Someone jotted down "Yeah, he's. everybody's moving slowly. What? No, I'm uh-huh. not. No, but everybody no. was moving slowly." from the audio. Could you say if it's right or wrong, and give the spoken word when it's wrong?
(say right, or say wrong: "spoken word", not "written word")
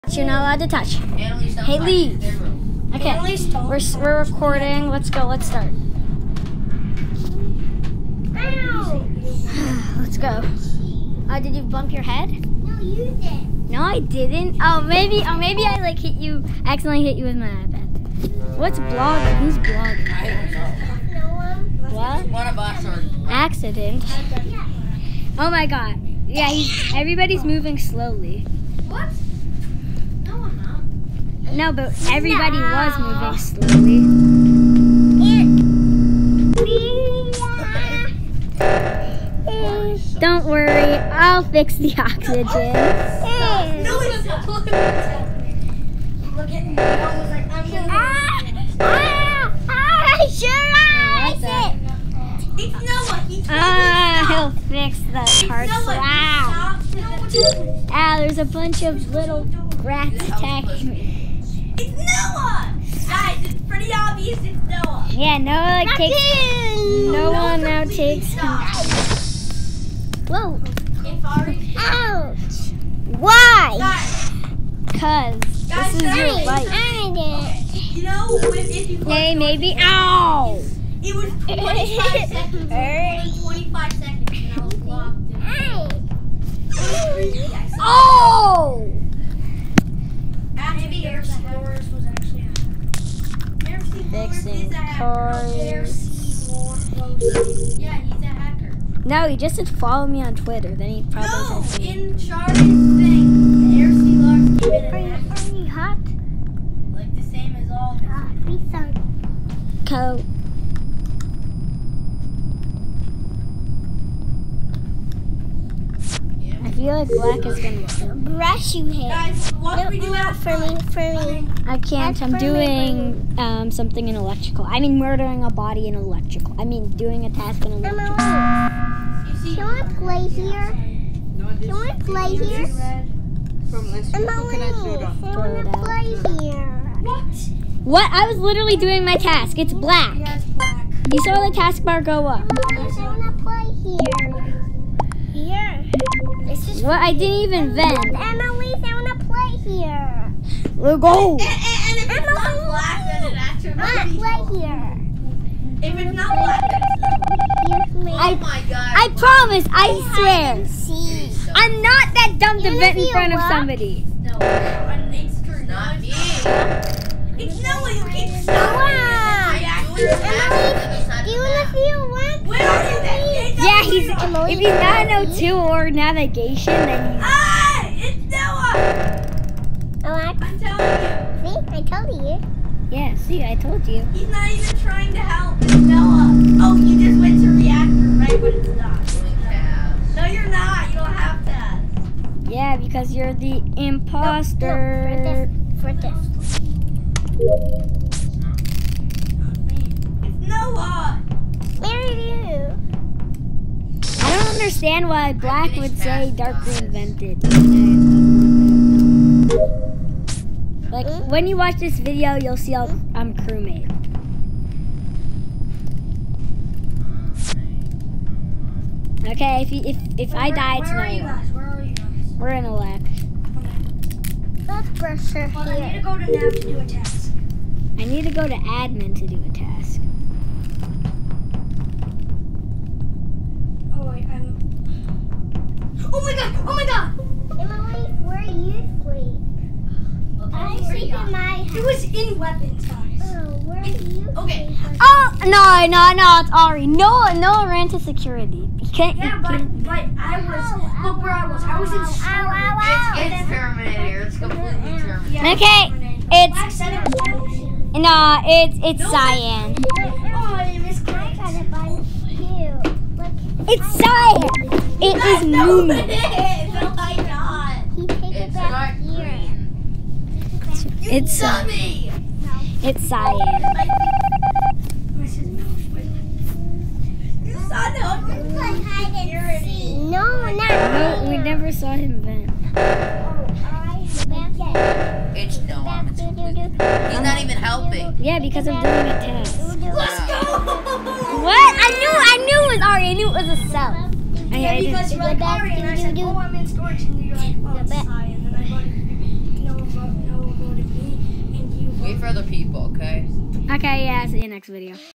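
right.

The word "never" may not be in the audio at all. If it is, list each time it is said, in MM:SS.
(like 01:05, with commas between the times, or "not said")
04:41.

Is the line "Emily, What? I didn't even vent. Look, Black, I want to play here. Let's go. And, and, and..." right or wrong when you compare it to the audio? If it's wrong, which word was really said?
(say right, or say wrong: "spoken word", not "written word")
wrong: "Emily", not "Black".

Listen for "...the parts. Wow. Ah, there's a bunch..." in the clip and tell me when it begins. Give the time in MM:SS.
00:54.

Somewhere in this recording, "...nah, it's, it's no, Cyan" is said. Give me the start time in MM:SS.
04:18.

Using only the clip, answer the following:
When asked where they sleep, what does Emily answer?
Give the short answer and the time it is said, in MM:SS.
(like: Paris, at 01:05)
In my house, at 04:00.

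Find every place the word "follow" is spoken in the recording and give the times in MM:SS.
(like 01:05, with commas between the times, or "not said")
01:39.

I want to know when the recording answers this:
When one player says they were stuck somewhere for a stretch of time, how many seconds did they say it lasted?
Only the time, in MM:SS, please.
01:23.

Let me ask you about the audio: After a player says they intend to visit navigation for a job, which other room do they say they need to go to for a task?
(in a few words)
admin.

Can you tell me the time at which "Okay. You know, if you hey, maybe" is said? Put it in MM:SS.
01:16.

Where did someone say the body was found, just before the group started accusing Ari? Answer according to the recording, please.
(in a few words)
weapons.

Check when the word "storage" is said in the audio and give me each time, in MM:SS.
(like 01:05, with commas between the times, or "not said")
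04:12, 04:56.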